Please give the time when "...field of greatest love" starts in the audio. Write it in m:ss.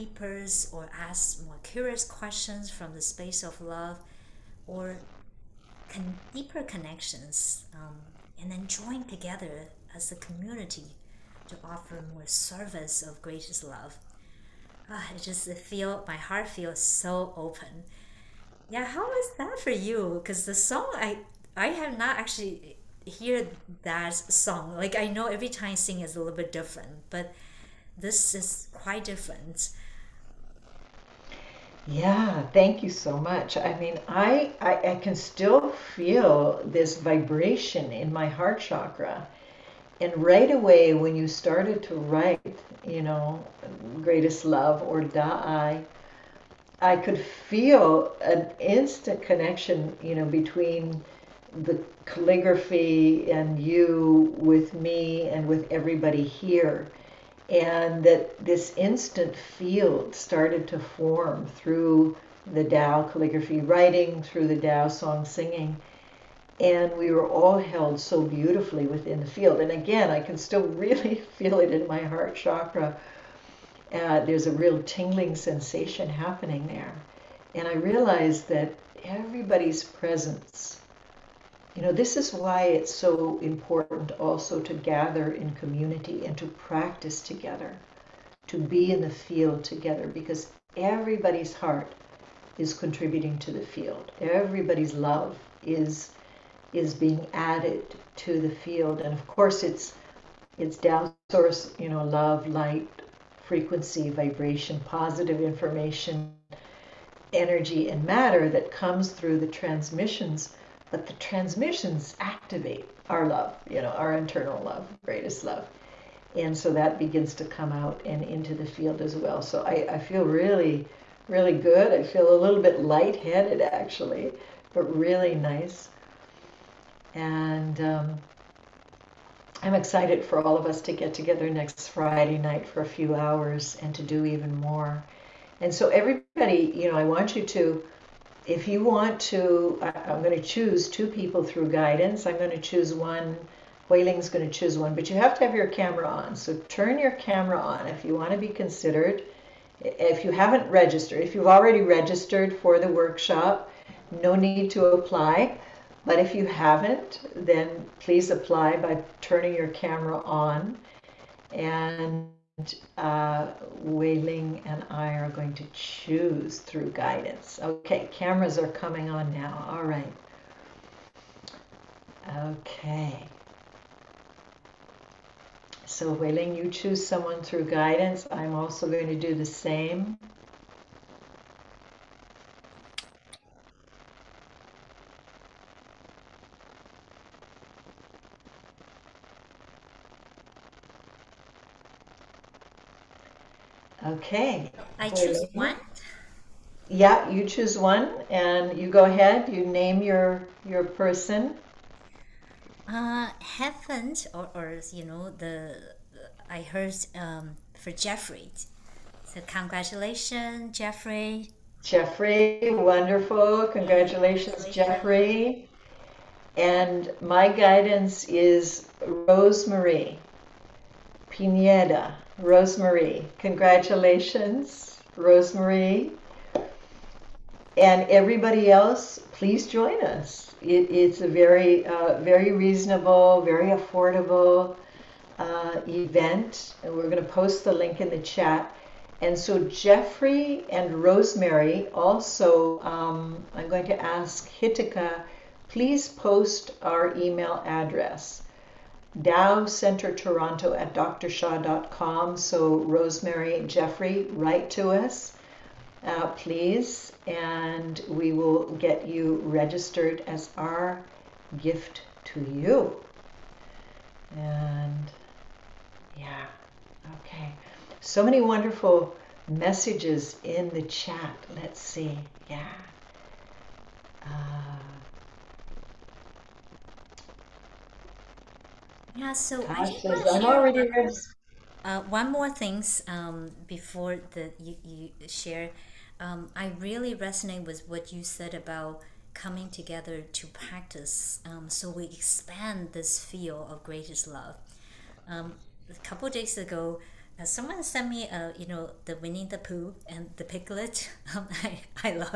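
4:53.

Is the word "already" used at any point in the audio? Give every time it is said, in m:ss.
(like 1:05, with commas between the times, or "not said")
2:31, 4:40.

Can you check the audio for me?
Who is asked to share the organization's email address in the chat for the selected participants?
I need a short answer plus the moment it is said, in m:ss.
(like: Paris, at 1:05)
Hitika, at 4:04.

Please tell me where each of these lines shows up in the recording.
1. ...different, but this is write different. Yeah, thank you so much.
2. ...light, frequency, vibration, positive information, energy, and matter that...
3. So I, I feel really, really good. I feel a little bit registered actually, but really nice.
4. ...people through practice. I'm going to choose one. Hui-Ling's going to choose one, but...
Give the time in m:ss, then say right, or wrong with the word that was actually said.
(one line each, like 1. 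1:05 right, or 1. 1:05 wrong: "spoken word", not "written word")
1. 0:26 wrong: "quite", not "write"
2. 1:42 right
3. 1:59 wrong: "lightheaded", not "registered"
4. 2:21 wrong: "guidance", not "practice".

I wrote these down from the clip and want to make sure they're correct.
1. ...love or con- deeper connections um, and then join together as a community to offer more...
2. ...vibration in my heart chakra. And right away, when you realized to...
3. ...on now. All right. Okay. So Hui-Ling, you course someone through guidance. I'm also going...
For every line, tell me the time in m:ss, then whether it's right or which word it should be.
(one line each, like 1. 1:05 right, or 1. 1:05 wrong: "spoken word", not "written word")
1. 0:03 right
2. 0:36 wrong: "started", not "realized"
3. 2:49 wrong: "choose", not "course".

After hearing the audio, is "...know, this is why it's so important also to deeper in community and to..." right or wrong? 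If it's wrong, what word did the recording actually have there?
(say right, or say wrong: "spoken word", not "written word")
wrong: "gather", not "deeper".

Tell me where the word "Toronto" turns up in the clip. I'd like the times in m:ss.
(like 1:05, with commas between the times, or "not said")
4:10.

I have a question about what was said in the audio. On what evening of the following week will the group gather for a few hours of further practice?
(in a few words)
Friday night.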